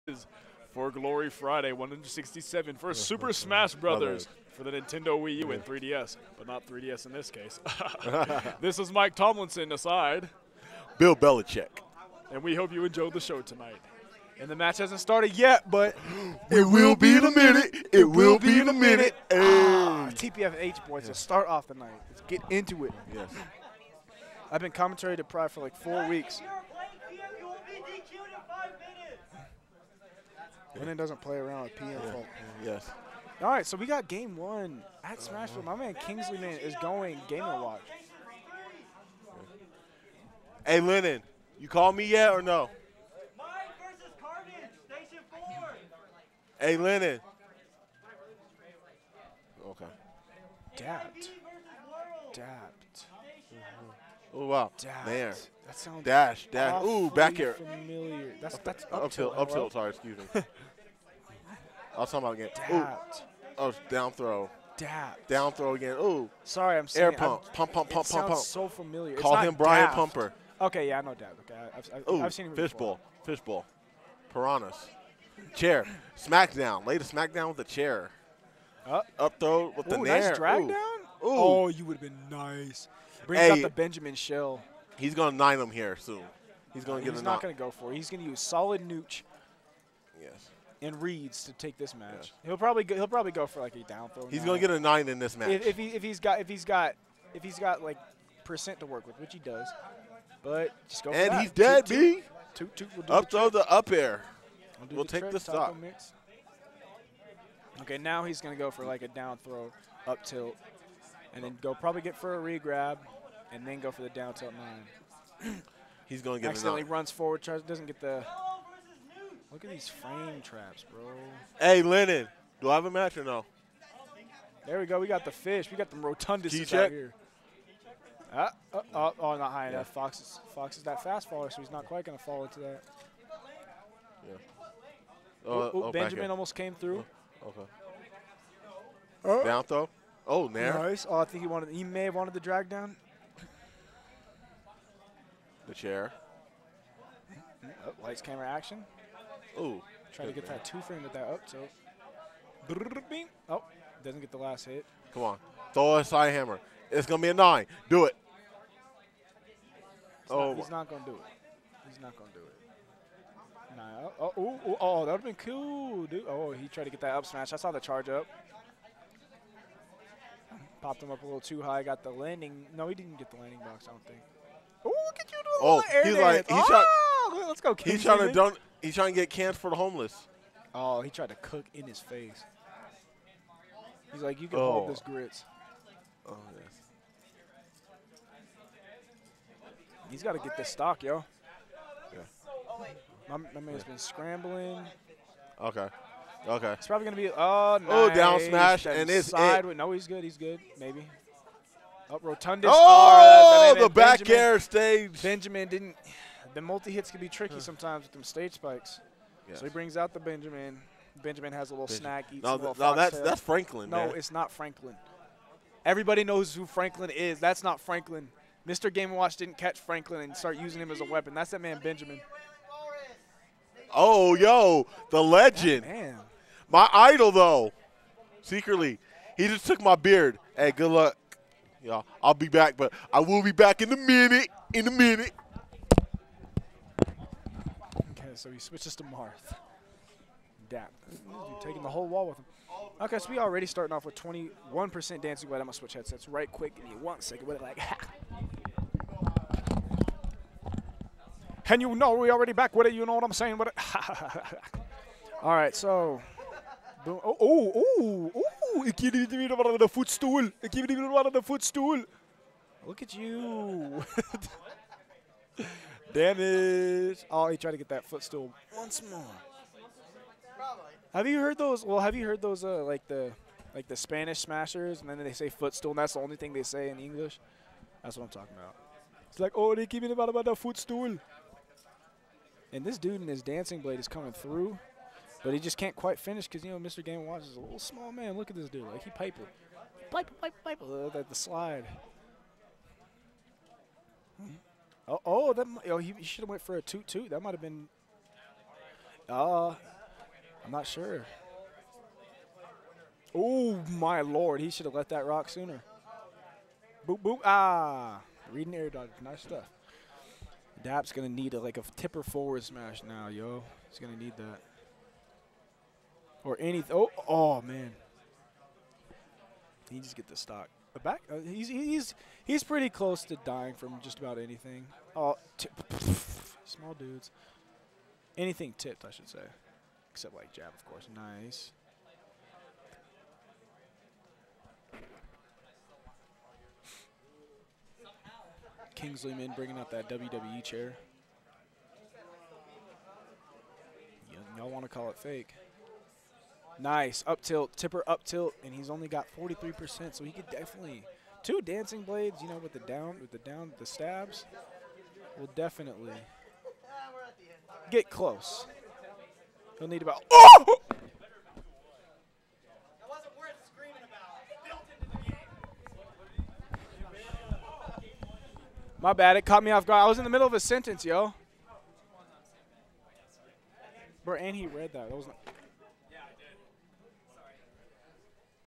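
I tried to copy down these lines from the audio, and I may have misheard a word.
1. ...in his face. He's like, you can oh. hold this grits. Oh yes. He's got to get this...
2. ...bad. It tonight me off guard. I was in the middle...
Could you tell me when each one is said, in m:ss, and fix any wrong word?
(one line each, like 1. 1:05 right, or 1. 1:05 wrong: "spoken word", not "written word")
1. 3:01 right
2. 6:09 wrong: "caught", not "tonight".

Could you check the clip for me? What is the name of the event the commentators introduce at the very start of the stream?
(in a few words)
Glory Friday.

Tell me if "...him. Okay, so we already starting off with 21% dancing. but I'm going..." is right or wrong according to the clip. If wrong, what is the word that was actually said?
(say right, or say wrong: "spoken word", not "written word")
right.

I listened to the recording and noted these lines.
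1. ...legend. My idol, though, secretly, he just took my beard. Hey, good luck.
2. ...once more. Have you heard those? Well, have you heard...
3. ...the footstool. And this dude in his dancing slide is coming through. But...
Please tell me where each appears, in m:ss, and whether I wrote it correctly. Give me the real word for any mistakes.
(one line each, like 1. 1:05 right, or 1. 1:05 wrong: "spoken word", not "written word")
1. 3:45 right
2. 4:28 right
3. 4:40 wrong: "blade", not "slide".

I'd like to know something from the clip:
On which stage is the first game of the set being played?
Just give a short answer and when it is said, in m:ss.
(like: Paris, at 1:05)
Smashville, at 0:35.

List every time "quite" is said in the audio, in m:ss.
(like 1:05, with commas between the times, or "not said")
2:11, 4:45.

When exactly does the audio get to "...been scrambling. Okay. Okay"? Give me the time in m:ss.
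3:13.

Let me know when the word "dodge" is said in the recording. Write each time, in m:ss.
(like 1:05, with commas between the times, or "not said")
5:08.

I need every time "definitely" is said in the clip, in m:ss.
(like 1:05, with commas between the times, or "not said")
5:50, 5:55.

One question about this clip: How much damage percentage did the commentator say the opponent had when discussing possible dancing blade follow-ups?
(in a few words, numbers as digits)
43%.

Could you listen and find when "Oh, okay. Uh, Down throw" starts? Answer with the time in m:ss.
2:17.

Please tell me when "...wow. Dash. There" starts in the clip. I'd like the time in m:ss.
0:54.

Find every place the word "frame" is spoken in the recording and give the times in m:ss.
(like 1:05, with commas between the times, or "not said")
1:59, 2:30.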